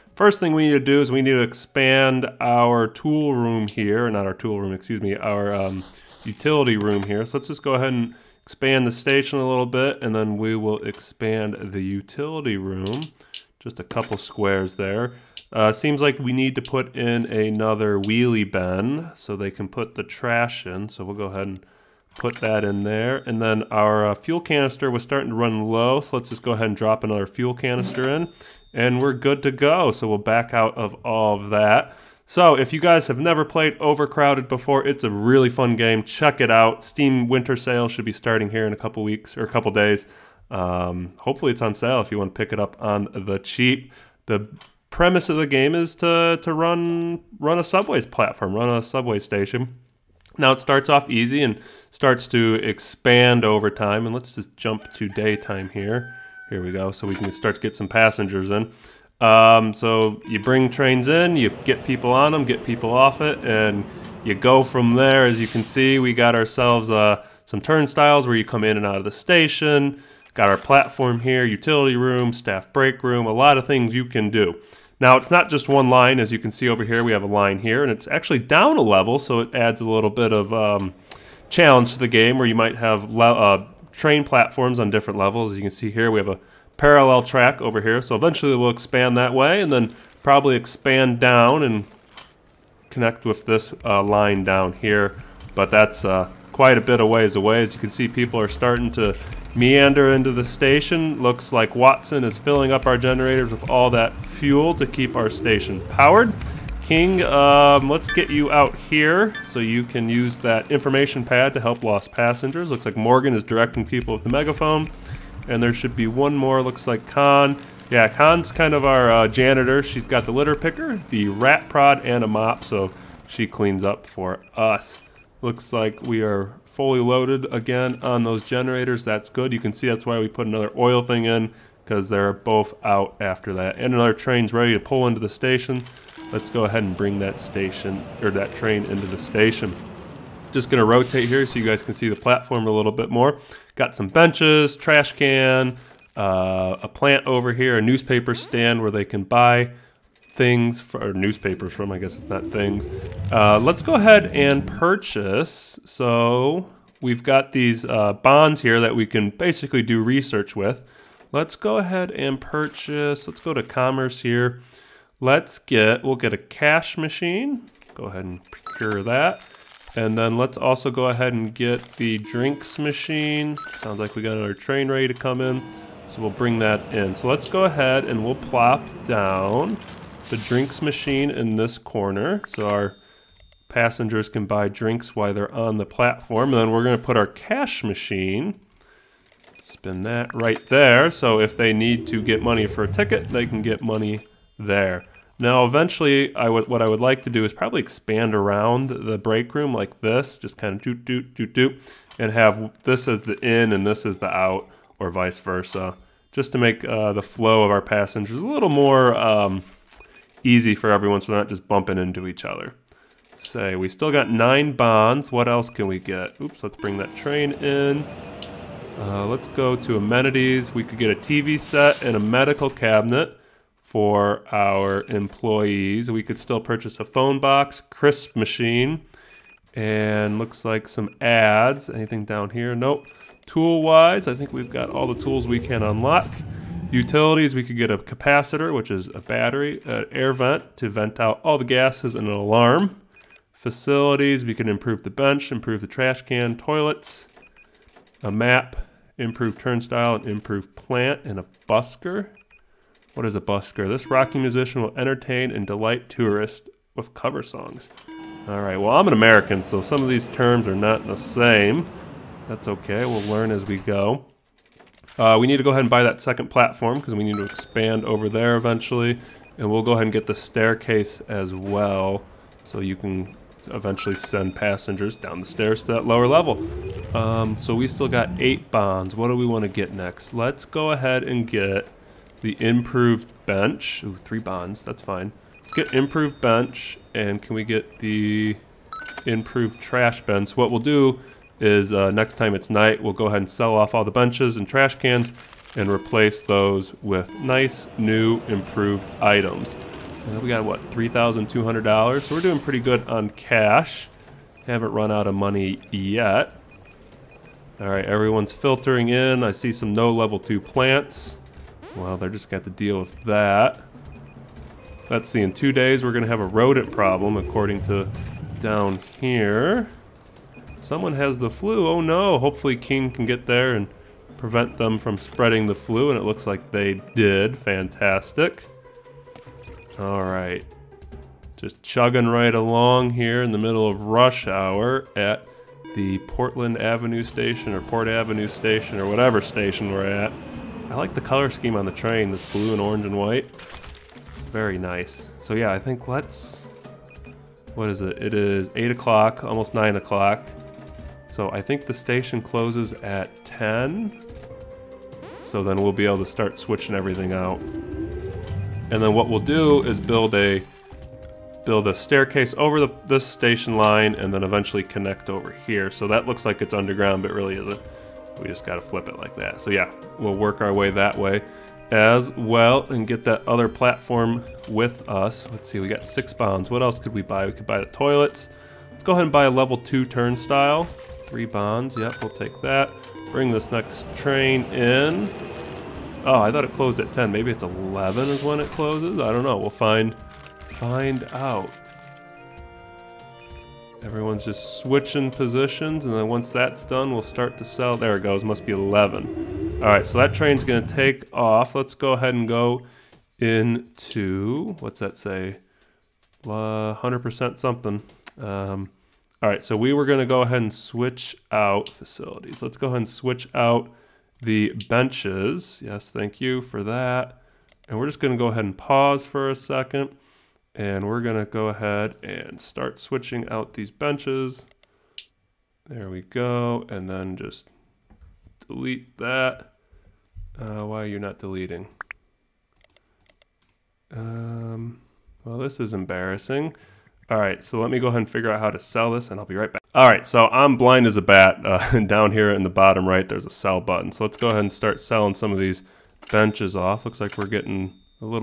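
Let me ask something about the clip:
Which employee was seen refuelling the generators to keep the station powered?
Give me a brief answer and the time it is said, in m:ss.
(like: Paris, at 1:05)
Watson, at 1:41.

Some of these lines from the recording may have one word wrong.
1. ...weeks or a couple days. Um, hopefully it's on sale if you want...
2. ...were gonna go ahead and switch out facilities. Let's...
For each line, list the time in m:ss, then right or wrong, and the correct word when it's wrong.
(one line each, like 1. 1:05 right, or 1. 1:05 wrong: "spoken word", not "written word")
1. 0:39 right
2. 6:49 right.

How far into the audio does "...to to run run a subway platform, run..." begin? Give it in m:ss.
0:45.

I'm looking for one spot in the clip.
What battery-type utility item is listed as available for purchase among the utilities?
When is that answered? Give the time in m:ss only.
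3:57.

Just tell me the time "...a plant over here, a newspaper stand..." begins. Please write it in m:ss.
2:26.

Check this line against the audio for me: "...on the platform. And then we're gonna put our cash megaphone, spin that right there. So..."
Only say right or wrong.
wrong.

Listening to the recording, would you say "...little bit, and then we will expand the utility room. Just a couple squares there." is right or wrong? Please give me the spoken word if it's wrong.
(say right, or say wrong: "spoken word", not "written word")
right.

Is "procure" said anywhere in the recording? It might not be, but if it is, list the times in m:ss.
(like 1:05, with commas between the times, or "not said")
2:48.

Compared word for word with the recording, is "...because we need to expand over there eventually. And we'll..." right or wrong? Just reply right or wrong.
right.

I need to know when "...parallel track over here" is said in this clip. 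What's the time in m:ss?
1:26.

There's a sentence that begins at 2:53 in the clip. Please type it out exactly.
Sounds like we got another train ready to come in.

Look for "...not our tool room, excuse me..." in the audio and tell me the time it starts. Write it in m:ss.
0:04.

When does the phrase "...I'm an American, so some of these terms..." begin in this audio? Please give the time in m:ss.
4:18.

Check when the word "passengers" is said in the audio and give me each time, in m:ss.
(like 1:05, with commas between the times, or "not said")
0:57, 1:52, 3:03, 3:27, 4:34.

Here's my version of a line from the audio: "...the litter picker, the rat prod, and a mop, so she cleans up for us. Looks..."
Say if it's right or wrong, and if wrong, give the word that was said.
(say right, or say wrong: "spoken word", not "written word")
right.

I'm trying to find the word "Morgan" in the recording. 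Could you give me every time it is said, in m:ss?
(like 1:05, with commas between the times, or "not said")
1:52.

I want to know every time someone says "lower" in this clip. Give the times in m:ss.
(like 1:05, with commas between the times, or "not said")
4:36.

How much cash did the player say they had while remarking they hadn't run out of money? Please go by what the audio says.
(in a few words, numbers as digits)
$3,200.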